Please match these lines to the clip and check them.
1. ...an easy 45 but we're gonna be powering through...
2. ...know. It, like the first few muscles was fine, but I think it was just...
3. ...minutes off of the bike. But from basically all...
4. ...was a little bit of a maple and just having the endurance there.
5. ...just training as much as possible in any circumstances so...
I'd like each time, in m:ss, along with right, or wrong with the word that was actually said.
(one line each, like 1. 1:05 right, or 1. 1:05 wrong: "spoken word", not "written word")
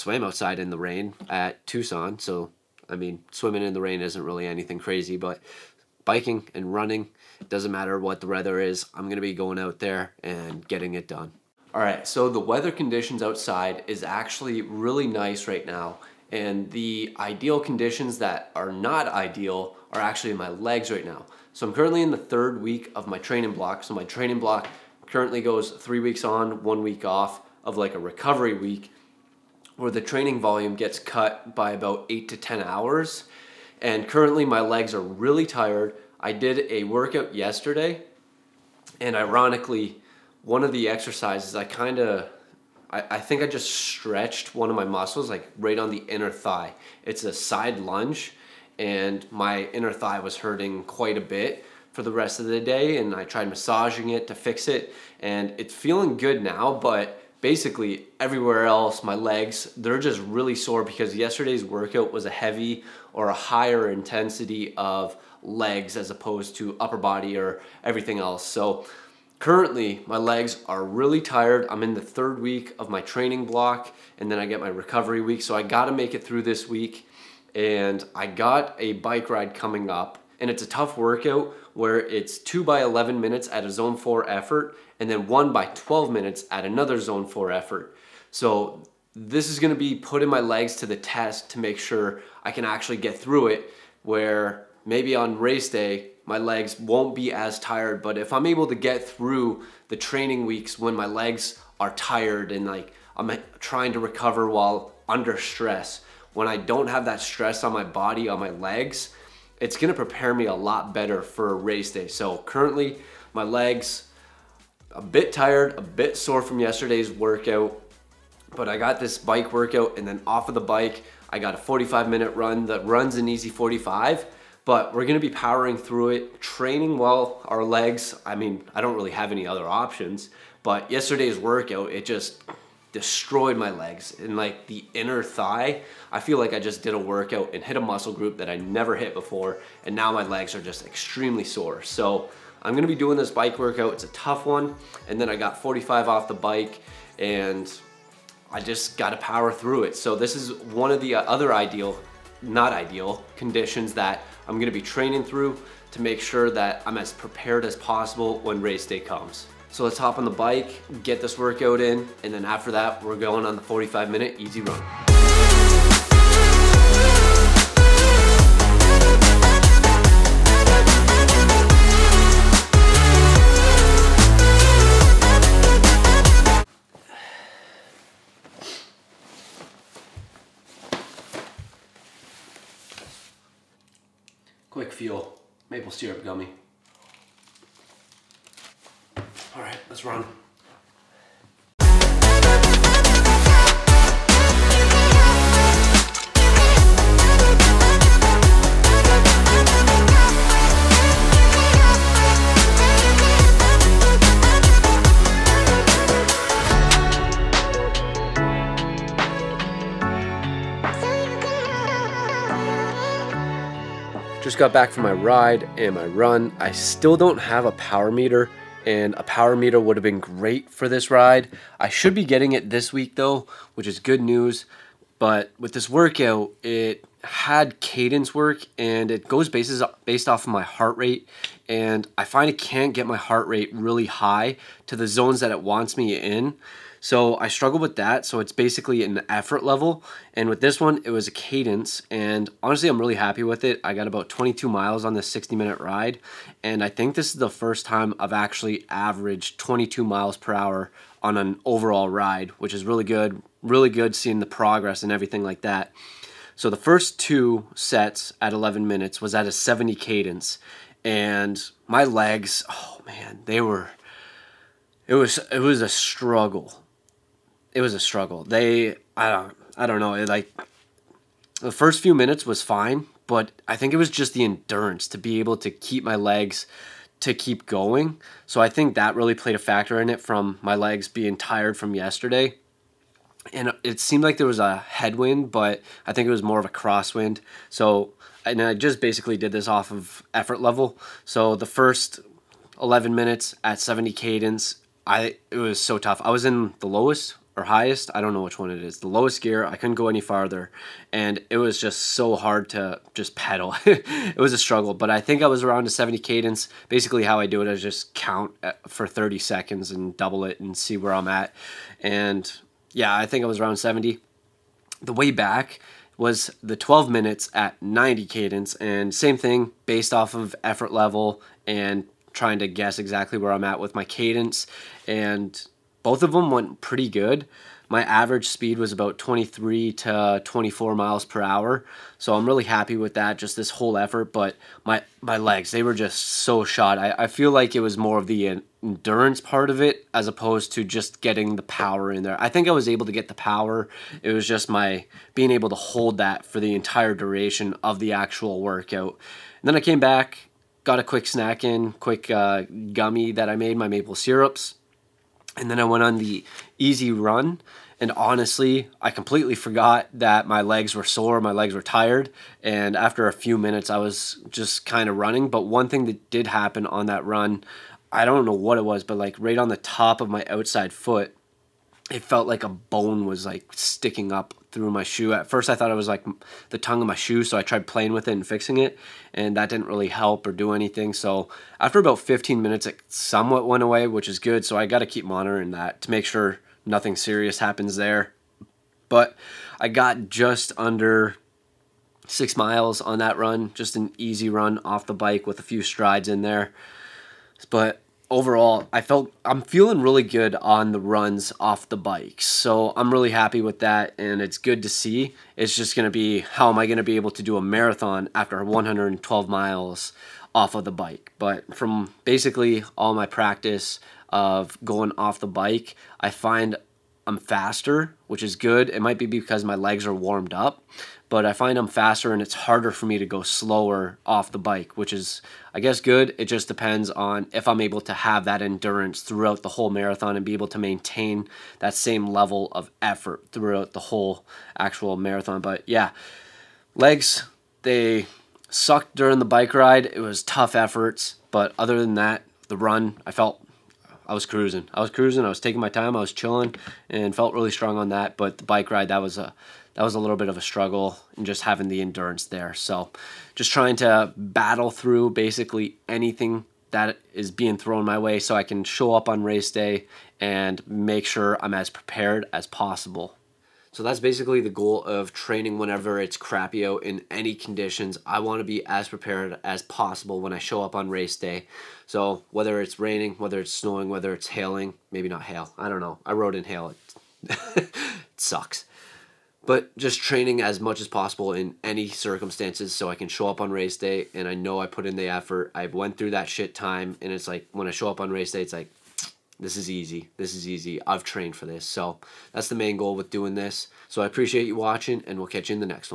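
1. 2:03 right
2. 4:29 wrong: "minutes", not "muscles"
3. 6:49 wrong: "miles", not "minutes"
4. 7:30 wrong: "struggle", not "maple"
5. 7:59 right.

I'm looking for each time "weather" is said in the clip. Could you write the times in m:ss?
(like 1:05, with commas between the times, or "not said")
0:08, 0:12.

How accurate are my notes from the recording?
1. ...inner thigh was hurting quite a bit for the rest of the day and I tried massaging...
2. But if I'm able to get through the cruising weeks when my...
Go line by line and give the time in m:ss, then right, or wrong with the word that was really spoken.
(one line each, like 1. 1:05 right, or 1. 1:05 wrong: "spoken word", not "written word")
1. 0:49 right
2. 1:38 wrong: "training", not "cruising".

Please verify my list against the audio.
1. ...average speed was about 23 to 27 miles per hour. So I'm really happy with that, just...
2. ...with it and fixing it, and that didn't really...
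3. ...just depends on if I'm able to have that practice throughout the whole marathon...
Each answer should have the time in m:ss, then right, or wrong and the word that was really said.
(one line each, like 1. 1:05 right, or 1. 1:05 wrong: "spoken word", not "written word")
1. 5:28 wrong: "24", not "27"
2. 6:18 right
3. 7:06 wrong: "endurance", not "practice".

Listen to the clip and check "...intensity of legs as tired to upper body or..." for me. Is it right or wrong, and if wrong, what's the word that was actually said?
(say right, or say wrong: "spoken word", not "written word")
wrong: "opposed", not "tired".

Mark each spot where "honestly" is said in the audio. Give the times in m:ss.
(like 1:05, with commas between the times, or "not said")
4:02, 5:58.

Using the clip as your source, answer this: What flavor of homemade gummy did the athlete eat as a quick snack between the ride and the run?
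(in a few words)
maple syrup.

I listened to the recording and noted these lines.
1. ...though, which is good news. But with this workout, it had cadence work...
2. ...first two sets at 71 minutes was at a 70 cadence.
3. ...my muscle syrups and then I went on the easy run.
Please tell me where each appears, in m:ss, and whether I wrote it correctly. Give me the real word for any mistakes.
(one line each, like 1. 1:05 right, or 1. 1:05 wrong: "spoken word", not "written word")
1. 3:43 right
2. 4:16 wrong: "11", not "71"
3. 5:53 wrong: "maple", not "muscle".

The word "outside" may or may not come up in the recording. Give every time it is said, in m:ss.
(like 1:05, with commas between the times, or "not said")
0:00, 0:13, 6:10.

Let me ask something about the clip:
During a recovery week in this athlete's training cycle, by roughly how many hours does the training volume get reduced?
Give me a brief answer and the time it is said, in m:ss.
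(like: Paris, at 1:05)
8 to 10 hours, at 0:32.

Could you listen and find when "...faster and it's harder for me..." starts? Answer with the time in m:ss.
7:01.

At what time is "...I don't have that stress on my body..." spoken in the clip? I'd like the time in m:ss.
1:46.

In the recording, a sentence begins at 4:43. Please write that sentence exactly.
And it seemed like there was a headwind, but I think it was more of a crosswind.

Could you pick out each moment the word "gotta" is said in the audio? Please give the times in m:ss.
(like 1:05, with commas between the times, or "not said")
1:15, 2:28.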